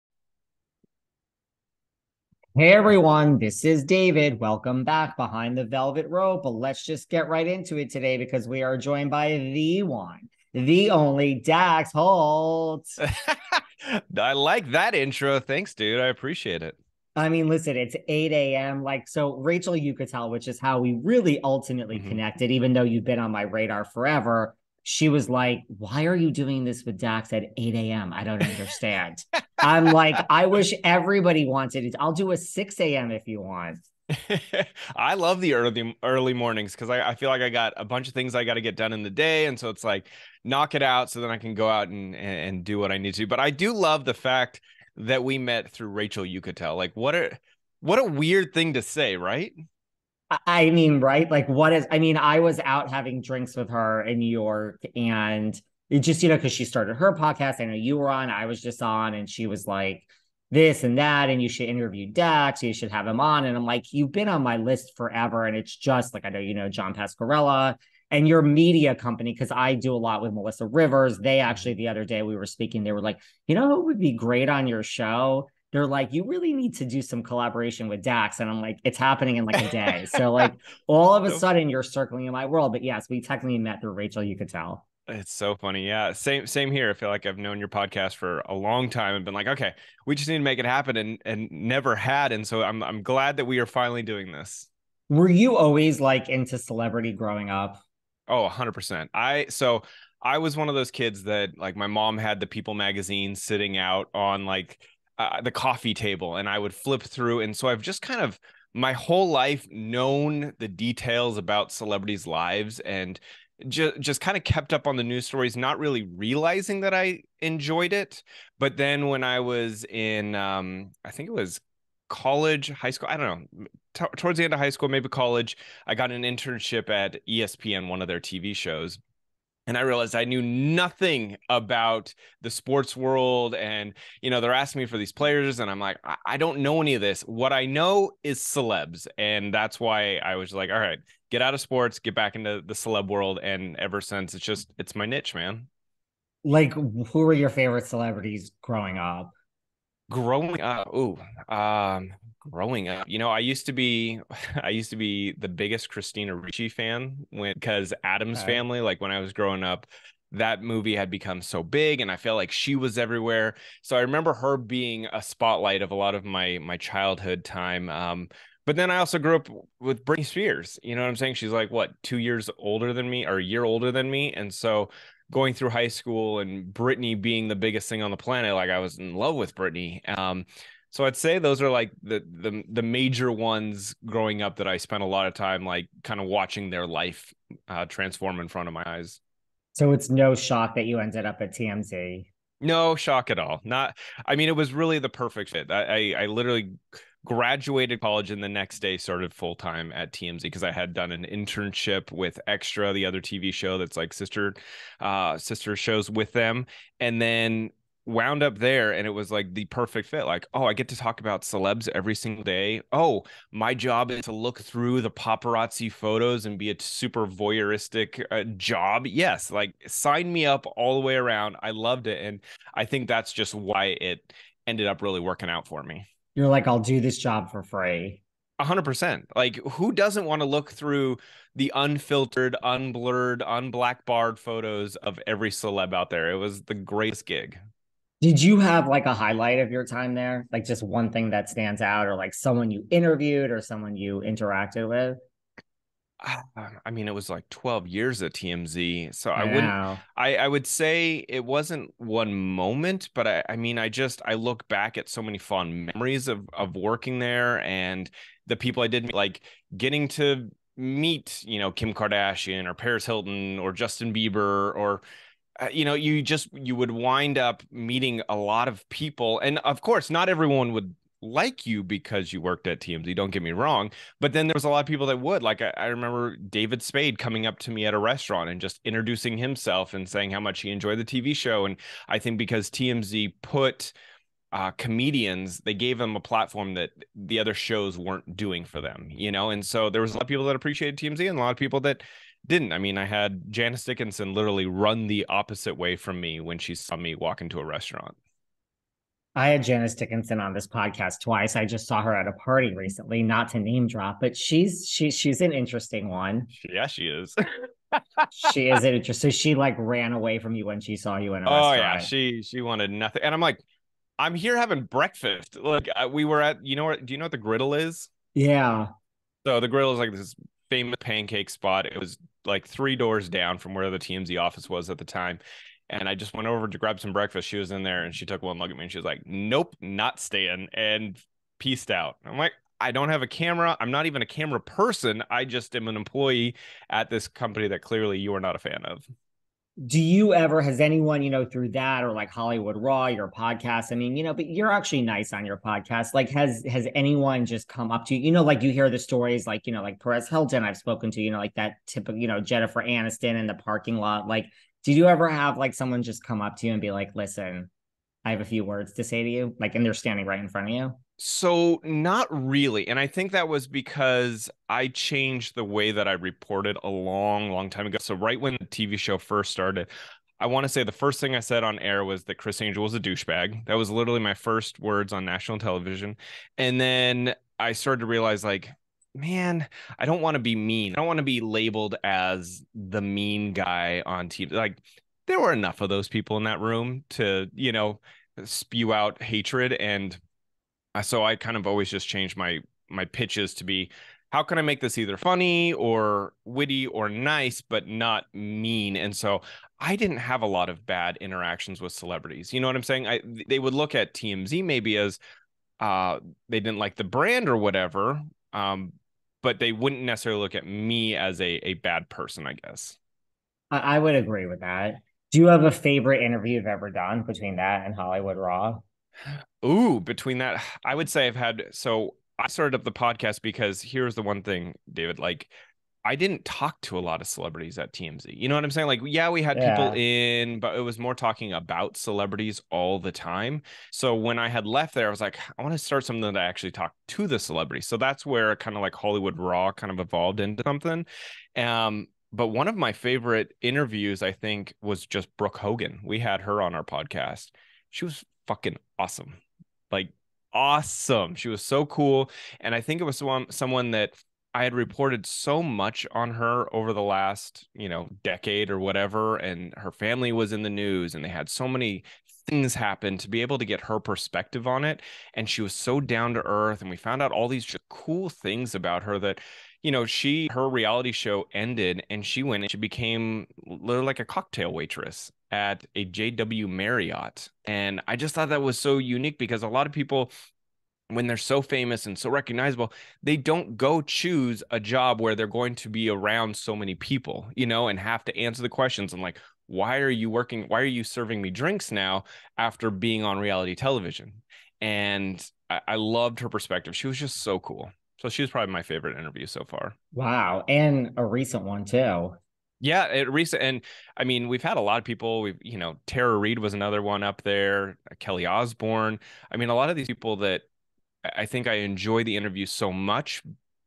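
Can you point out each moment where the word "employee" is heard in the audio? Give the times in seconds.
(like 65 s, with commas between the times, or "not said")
335 s.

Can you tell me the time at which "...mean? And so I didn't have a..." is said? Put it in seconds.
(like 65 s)
398 s.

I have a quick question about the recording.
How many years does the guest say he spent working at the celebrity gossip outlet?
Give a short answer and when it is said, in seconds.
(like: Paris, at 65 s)
12, at 247 s.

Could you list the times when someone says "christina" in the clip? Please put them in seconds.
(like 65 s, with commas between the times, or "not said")
155 s.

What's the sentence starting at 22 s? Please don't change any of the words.
connected, even though you've been on my radar forever, she was like, Why are you doing this with Dax at 8 a.m.?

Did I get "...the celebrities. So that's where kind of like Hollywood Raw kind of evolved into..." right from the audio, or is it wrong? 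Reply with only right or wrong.
right.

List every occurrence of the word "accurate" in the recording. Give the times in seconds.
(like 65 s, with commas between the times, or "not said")
not said.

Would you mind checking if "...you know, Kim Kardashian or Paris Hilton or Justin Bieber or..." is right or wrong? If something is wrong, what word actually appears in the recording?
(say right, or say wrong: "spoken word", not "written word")
right.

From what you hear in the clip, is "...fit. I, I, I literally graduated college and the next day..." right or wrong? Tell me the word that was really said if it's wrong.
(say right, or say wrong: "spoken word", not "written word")
right.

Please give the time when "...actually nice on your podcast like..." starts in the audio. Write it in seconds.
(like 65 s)
344 s.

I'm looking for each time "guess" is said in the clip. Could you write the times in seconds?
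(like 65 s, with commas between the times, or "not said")
412 s.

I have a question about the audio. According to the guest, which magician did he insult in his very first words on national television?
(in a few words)
Criss Angel.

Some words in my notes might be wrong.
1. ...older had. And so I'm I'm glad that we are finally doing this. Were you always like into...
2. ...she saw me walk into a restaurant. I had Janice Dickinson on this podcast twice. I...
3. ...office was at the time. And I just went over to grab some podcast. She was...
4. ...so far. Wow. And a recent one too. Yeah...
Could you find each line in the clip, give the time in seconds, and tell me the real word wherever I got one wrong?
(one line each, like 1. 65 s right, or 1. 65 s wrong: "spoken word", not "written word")
1. 91 s wrong: "never", not "older"
2. 296 s right
3. 324 s wrong: "breakfast", not "podcast"
4. 499 s right.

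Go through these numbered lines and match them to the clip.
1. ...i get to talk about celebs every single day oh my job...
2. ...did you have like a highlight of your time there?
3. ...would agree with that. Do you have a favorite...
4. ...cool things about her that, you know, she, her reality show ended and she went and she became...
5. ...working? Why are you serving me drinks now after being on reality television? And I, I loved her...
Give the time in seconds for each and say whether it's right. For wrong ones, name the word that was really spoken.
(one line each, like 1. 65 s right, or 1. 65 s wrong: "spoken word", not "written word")
1. 210 s right
2. 238 s right
3. 413 s right
4. 467 s right
5. 490 s right.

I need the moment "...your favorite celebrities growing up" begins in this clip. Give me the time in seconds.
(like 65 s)
147 s.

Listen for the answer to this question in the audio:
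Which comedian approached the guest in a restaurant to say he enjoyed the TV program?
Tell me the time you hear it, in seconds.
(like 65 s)
276 s.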